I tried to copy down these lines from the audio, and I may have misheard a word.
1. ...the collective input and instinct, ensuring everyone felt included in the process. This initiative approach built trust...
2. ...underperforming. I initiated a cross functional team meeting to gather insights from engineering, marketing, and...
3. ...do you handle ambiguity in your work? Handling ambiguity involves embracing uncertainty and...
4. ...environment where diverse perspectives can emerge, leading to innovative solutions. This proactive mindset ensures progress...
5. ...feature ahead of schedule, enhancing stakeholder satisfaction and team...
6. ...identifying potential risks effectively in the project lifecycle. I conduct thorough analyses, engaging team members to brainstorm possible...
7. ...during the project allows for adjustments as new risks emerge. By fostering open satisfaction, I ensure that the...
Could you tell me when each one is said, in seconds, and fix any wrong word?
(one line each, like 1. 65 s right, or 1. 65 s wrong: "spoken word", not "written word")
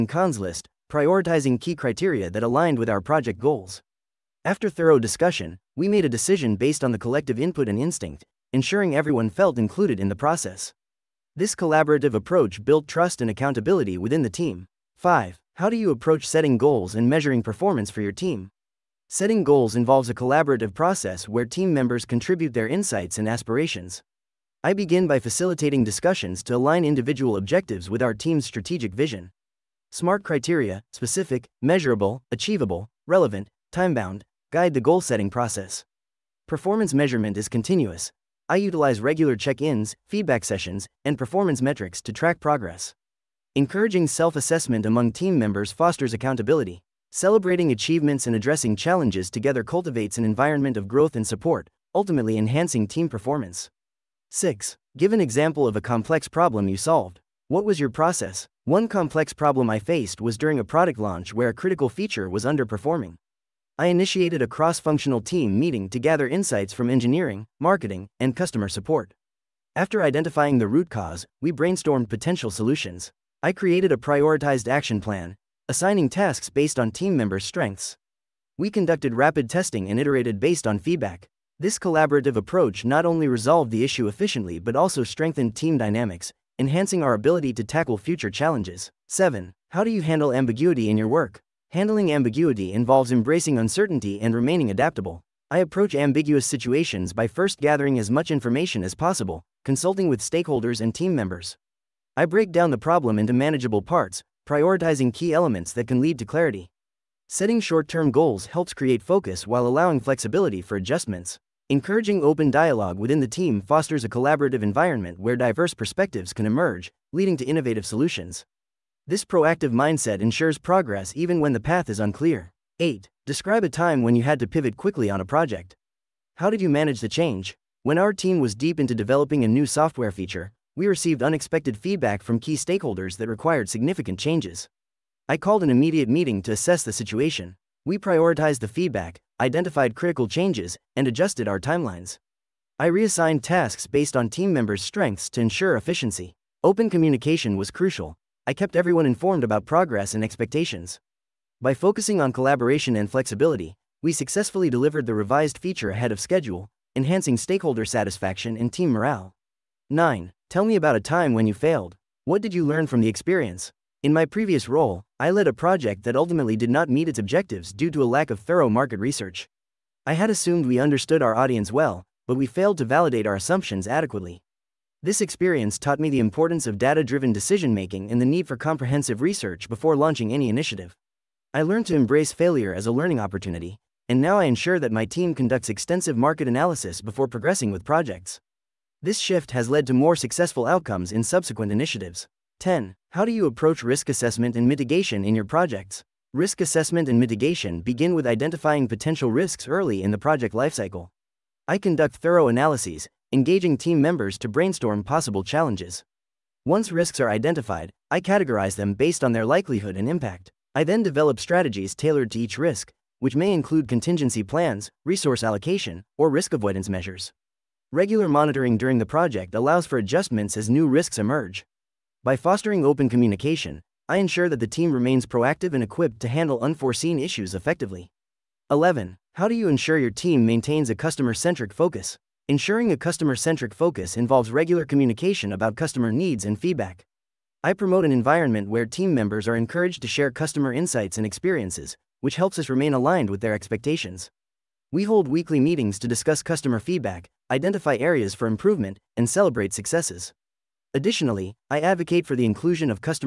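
1. 6 s wrong: "collaborative", not "initiative"
2. 62 s right
3. 89 s right
4. 114 s right
5. 155 s right
6. 198 s wrong: "early", not "effectively"
7. 218 s wrong: "communication", not "satisfaction".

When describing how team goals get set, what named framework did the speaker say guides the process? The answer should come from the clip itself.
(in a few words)
SMART.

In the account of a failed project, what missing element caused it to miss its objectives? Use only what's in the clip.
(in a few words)
thorough market research.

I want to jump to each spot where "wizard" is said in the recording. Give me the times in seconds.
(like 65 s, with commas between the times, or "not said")
not said.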